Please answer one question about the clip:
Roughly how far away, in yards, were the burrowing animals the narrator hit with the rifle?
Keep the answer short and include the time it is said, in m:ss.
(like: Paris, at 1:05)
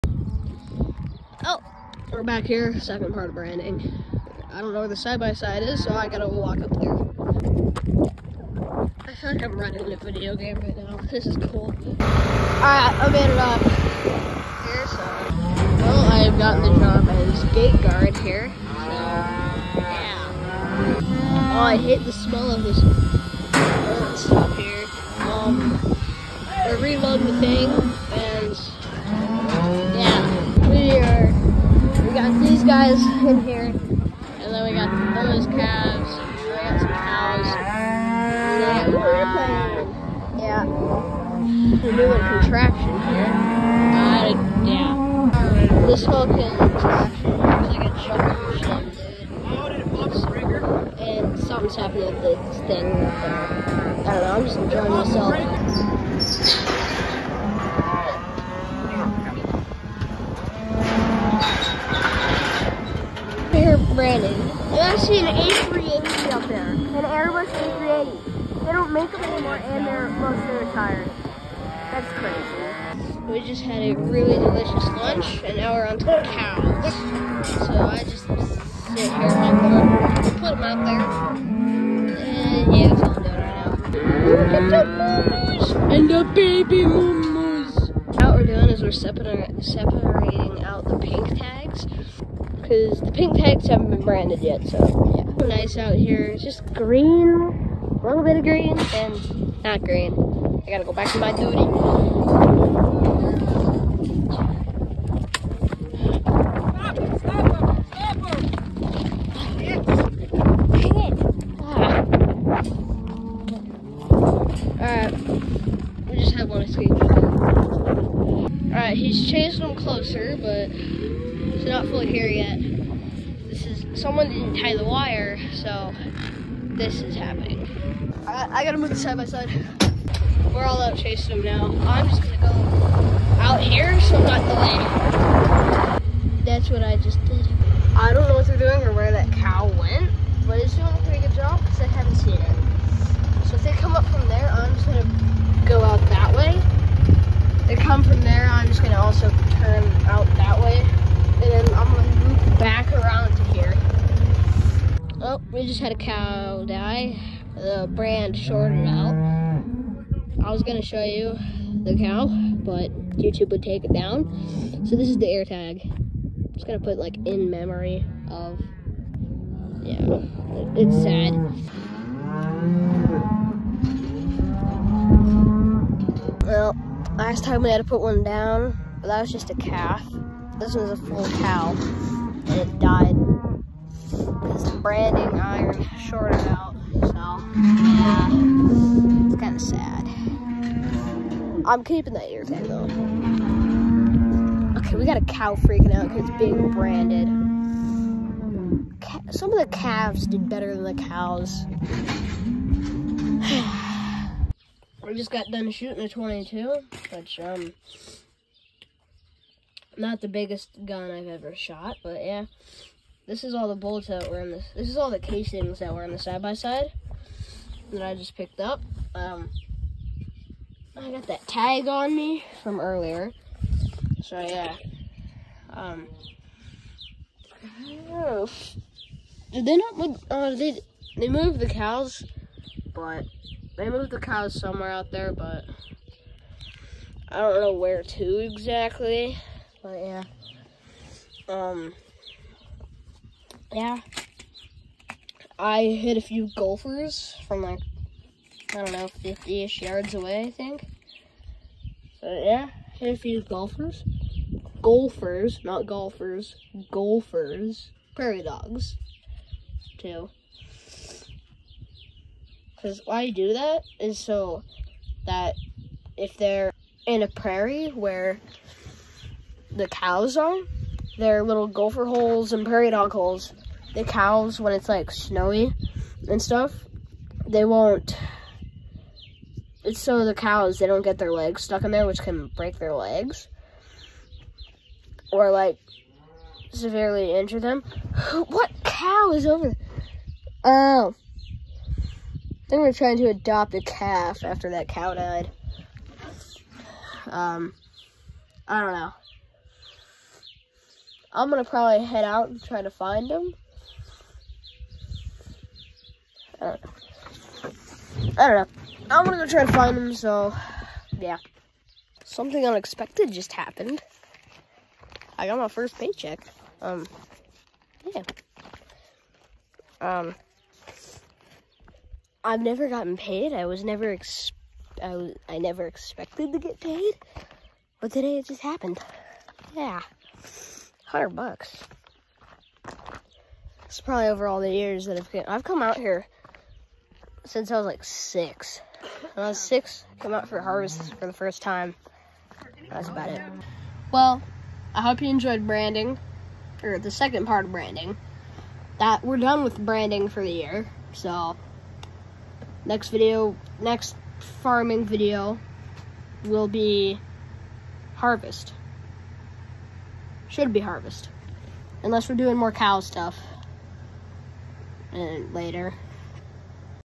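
50 yards, at 4:09.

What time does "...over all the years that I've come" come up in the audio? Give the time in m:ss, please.
5:34.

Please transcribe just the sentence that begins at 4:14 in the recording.
Golfers, not golfers, golfers, prairie dogs, too.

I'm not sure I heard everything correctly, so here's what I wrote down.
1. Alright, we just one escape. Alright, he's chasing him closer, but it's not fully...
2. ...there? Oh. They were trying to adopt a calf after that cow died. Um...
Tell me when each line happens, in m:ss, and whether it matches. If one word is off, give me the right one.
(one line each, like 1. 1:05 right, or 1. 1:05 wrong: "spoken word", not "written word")
1. 1:54 right
2. 4:49 right.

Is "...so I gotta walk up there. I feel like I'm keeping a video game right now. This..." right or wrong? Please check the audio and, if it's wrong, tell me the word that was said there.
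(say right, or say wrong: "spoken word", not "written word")
wrong: "running", not "keeping".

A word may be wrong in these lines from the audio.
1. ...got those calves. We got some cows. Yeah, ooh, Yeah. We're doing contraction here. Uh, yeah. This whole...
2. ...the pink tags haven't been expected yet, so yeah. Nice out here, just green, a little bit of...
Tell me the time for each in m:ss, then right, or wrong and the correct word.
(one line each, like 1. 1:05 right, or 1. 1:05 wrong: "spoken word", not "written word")
1. 0:34 right
2. 1:33 wrong: "branded", not "expected".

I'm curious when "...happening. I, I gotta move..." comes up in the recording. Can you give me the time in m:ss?
2:07.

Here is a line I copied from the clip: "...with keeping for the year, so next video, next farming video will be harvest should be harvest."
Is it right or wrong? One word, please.
wrong.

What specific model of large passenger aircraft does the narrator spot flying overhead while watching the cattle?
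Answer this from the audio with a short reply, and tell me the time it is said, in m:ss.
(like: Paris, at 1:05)
Airbus A380, at 1:07.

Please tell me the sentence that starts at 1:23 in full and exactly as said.
Look at the moomoos and the baby moomoos.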